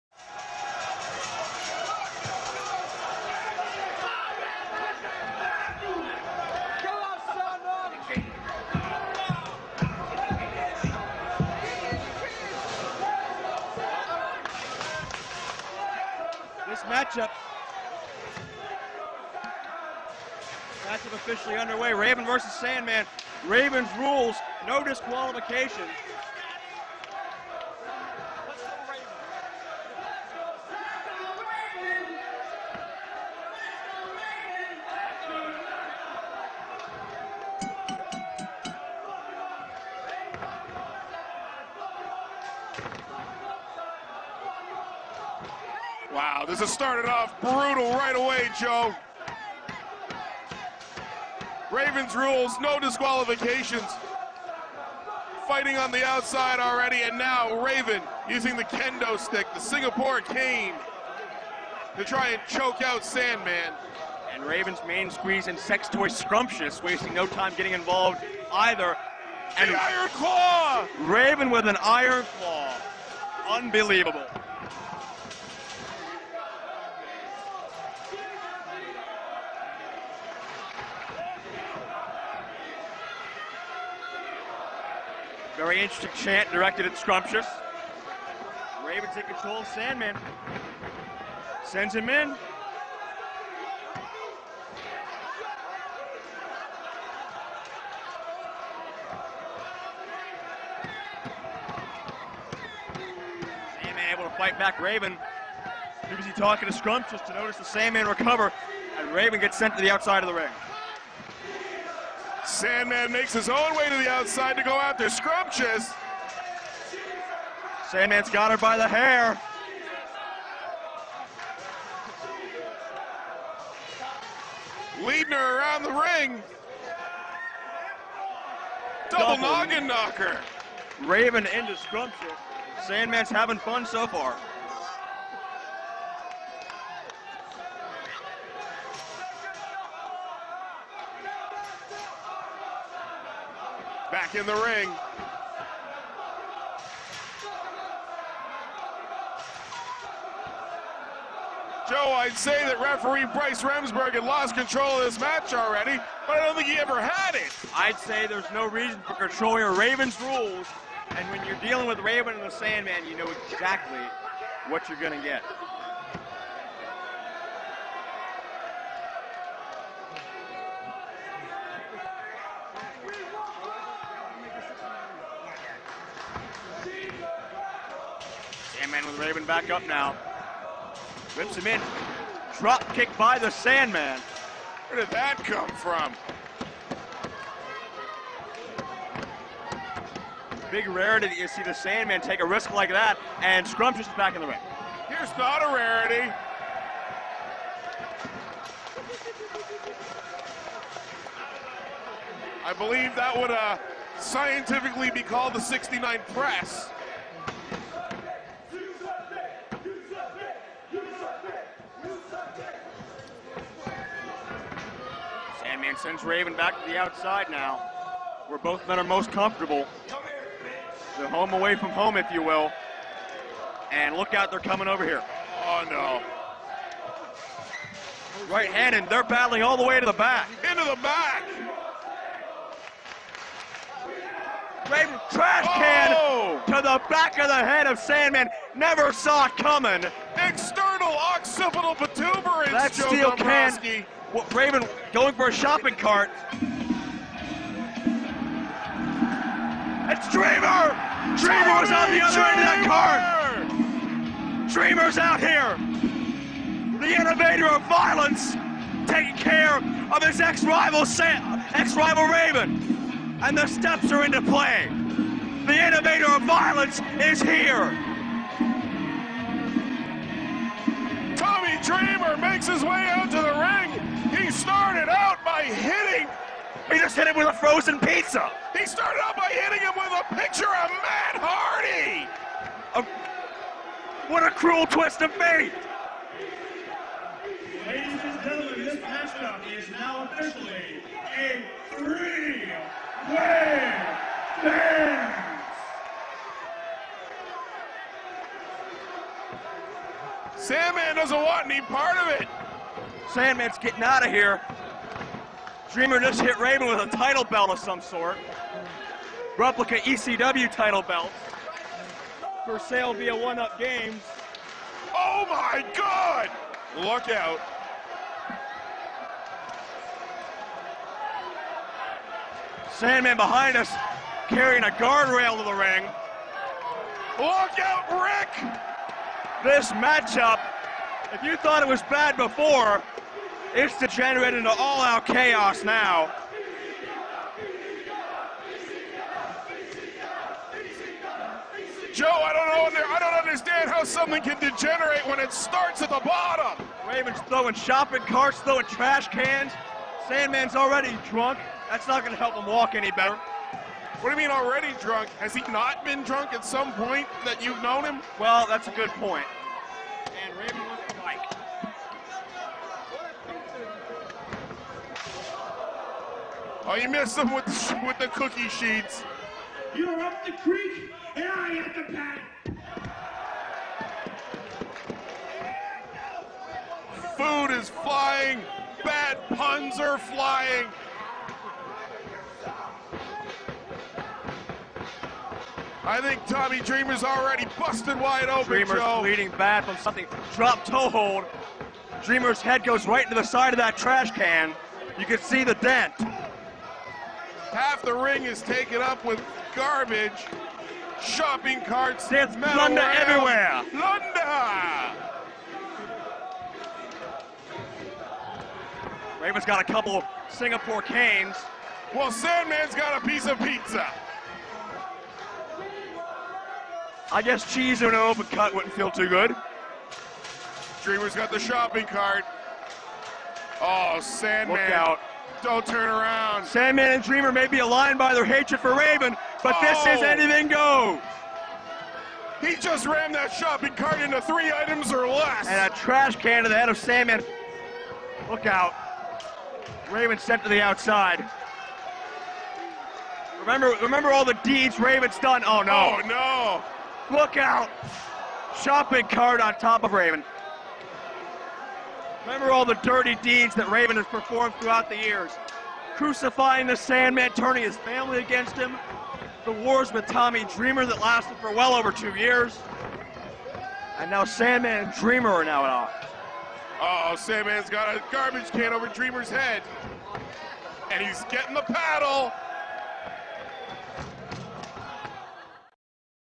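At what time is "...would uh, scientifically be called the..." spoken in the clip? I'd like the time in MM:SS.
03:23.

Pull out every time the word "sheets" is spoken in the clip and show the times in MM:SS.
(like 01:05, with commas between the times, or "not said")
06:08.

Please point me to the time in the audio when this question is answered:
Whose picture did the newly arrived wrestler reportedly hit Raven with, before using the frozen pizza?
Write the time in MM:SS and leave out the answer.
04:40.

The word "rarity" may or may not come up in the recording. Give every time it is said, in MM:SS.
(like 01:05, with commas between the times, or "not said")
03:10, 03:15.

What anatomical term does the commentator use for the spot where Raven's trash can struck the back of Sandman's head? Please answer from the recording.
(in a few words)
External occipital protuberance.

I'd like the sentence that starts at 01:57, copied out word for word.
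Sandman's got her by the hair.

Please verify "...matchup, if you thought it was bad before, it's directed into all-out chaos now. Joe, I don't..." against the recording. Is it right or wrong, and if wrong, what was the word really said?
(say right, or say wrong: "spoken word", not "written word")
wrong: "degenerated", not "directed".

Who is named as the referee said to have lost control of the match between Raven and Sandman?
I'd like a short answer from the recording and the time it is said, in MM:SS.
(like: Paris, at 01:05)
Bryce Remsburg, at 02:33.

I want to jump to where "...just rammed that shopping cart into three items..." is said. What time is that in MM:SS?
07:12.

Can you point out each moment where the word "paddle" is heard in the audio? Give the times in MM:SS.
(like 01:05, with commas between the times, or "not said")
06:12, 07:51.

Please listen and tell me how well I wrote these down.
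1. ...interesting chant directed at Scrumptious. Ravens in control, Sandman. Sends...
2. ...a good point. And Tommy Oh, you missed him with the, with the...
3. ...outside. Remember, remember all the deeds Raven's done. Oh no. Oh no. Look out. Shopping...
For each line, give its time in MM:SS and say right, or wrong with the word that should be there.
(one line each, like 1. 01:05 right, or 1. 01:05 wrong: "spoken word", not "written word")
1. 01:25 right
2. 05:58 wrong: "Raven", not "Tommy"
3. 07:20 right.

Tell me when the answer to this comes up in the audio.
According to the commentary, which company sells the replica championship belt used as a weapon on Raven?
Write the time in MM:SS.
05:13.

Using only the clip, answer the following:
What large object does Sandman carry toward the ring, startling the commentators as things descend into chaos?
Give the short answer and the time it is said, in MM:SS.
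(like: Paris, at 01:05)
A guardrail, at 05:24.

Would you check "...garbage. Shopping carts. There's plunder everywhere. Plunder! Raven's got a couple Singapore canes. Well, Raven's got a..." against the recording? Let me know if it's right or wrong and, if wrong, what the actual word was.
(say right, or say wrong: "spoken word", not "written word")
wrong: "Sandman", not "Raven".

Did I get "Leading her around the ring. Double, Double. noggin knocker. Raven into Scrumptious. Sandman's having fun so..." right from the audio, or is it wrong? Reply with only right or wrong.
right.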